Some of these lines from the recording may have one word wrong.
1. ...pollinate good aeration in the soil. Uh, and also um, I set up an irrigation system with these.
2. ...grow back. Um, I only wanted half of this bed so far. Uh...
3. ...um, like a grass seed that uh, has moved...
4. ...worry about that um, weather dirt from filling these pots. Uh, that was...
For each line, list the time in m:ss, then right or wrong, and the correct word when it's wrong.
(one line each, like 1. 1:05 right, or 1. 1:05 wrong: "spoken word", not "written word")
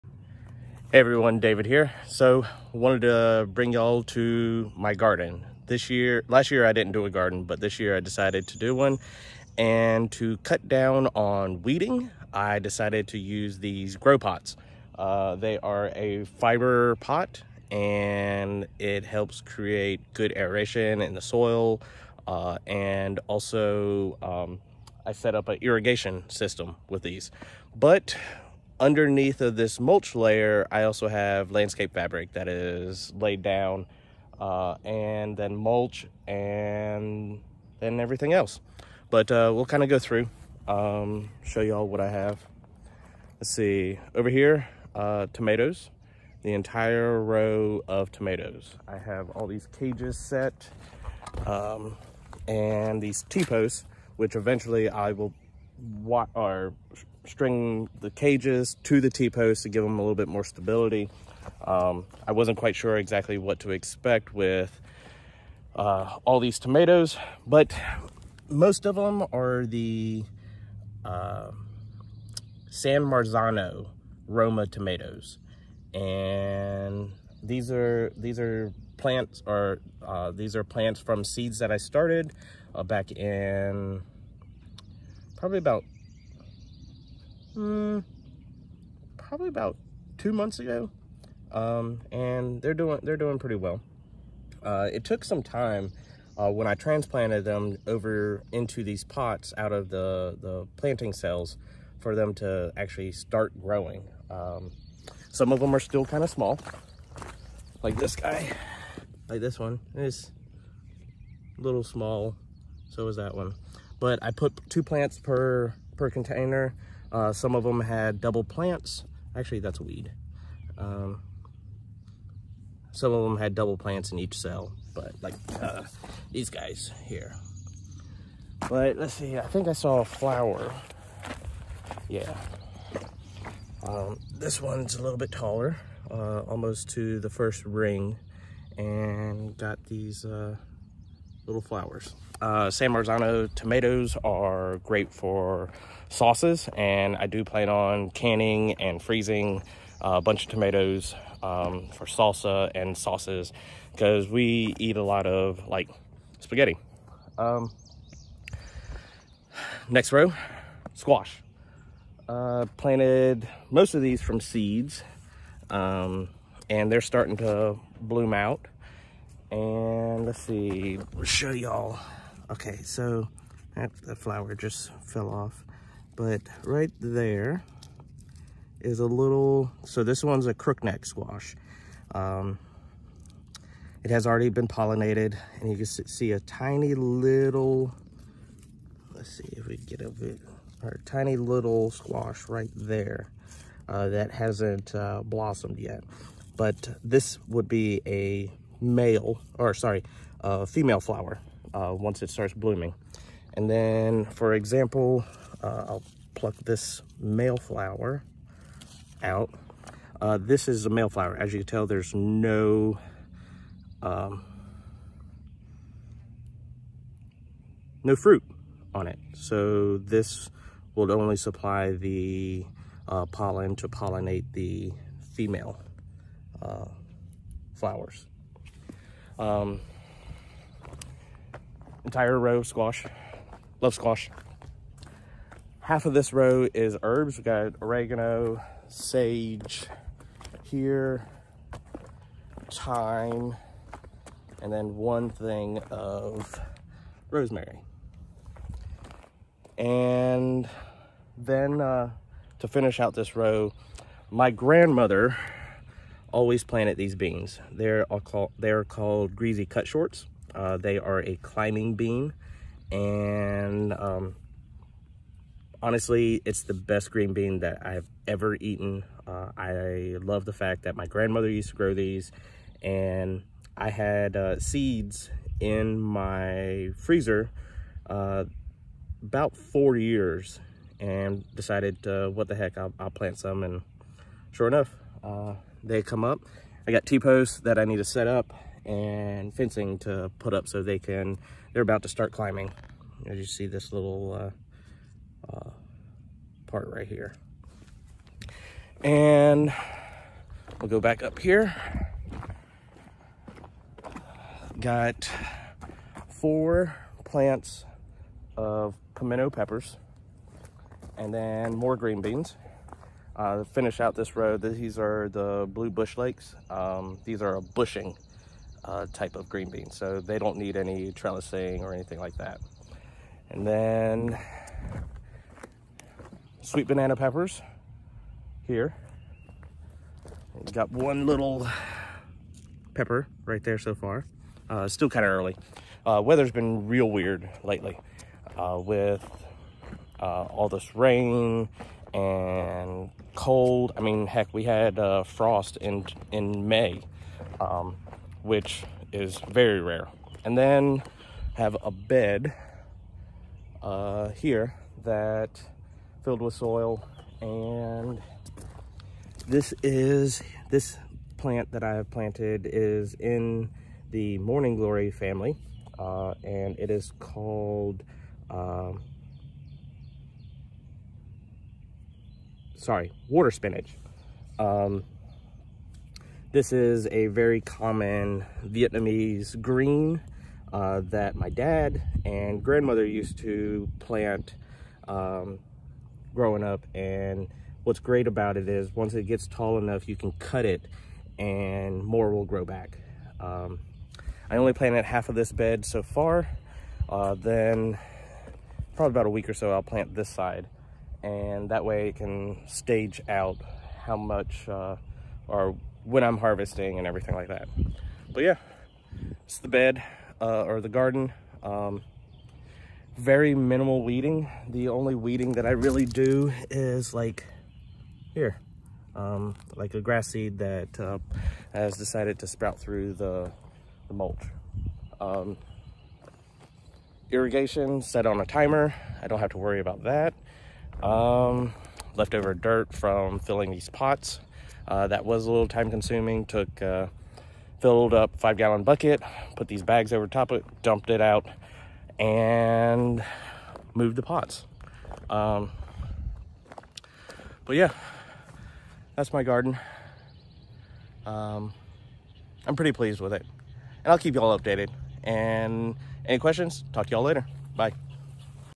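1. 0:19 wrong: "create", not "pollinate"
2. 6:32 wrong: "planted", not "wanted"
3. 6:59 wrong: "decided", not "moved"
4. 7:09 wrong: "leftover", not "weather".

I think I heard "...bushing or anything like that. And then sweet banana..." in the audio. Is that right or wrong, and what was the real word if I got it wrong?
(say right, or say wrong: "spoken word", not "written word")
wrong: "trellising", not "bushing".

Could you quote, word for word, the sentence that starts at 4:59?
And we'll go back up here.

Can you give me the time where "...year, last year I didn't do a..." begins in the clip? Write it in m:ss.
0:05.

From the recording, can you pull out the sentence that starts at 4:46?
I got T-posts that I need to set up and fencing to put up so they can, they're about to start climbing.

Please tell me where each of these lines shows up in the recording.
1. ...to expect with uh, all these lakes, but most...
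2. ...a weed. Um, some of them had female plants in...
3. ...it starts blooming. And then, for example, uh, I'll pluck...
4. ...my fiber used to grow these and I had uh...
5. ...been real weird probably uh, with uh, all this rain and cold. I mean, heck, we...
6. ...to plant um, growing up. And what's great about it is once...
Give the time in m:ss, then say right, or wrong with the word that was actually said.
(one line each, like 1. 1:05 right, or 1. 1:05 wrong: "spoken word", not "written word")
1. 1:03 wrong: "tomatoes", not "lakes"
2. 1:59 wrong: "double", not "female"
3. 3:22 right
4. 4:30 wrong: "grandmother", not "fiber"
5. 5:36 wrong: "lately", not "probably"
6. 6:23 right.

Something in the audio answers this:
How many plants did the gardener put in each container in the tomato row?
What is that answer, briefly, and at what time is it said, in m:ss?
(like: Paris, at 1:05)
2, at 1:54.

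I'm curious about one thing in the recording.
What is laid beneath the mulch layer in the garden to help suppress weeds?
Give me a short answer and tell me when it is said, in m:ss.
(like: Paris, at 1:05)
Landscape fabric, at 0:31.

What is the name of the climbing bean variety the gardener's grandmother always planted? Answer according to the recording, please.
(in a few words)
Greasy cut shorts.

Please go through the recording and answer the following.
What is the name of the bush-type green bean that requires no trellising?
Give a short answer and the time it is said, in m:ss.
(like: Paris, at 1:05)
Blue bush lakes, at 5:15.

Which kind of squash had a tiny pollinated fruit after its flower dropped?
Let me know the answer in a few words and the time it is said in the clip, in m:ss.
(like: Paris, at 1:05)
Crookneck squash, at 3:00.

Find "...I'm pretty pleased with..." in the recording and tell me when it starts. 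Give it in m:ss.
7:32.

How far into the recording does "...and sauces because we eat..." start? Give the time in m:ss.
2:32.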